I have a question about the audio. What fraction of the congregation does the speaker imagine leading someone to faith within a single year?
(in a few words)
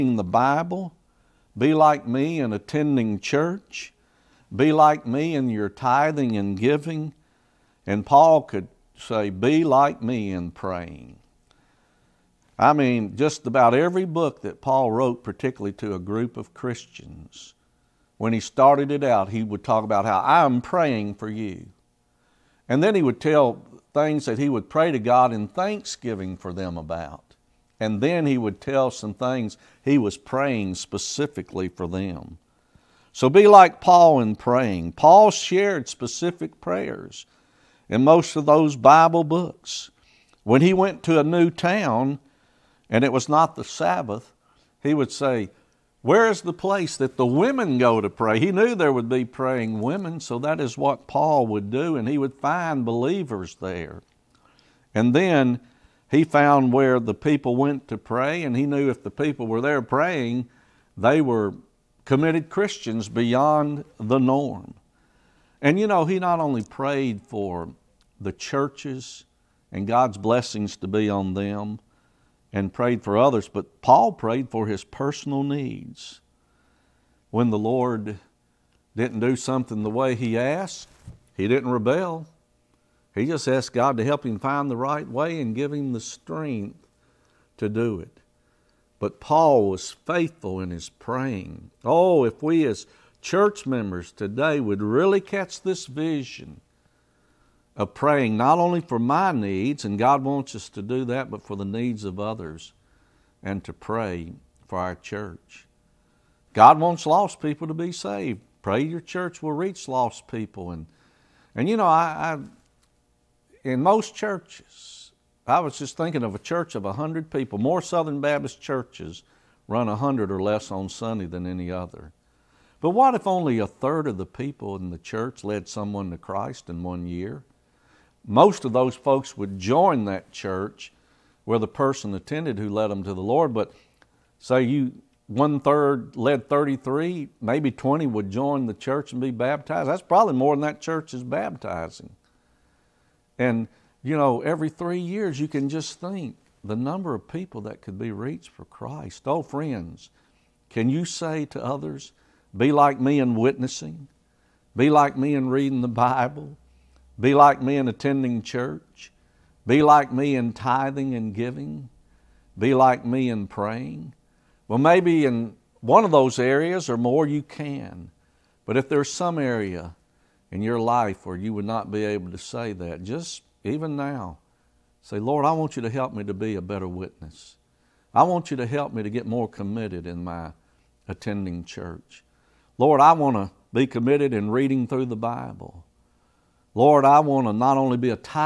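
a third.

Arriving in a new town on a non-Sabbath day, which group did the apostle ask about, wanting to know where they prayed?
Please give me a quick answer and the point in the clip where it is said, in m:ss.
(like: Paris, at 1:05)
the women, at 0:47.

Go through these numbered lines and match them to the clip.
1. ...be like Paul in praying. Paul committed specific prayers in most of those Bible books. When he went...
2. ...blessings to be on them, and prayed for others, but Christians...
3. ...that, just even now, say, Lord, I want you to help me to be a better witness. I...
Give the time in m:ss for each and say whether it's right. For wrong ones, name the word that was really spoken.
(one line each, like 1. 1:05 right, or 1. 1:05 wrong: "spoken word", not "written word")
1. 0:33 wrong: "shared", not "committed"
2. 1:10 wrong: "Paul", not "Christians"
3. 2:52 right.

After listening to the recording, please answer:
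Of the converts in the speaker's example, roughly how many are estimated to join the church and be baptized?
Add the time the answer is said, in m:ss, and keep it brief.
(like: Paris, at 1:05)
20, at 2:17.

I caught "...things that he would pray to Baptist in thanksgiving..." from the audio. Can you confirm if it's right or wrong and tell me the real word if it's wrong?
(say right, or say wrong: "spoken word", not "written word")
wrong: "God", not "Baptist".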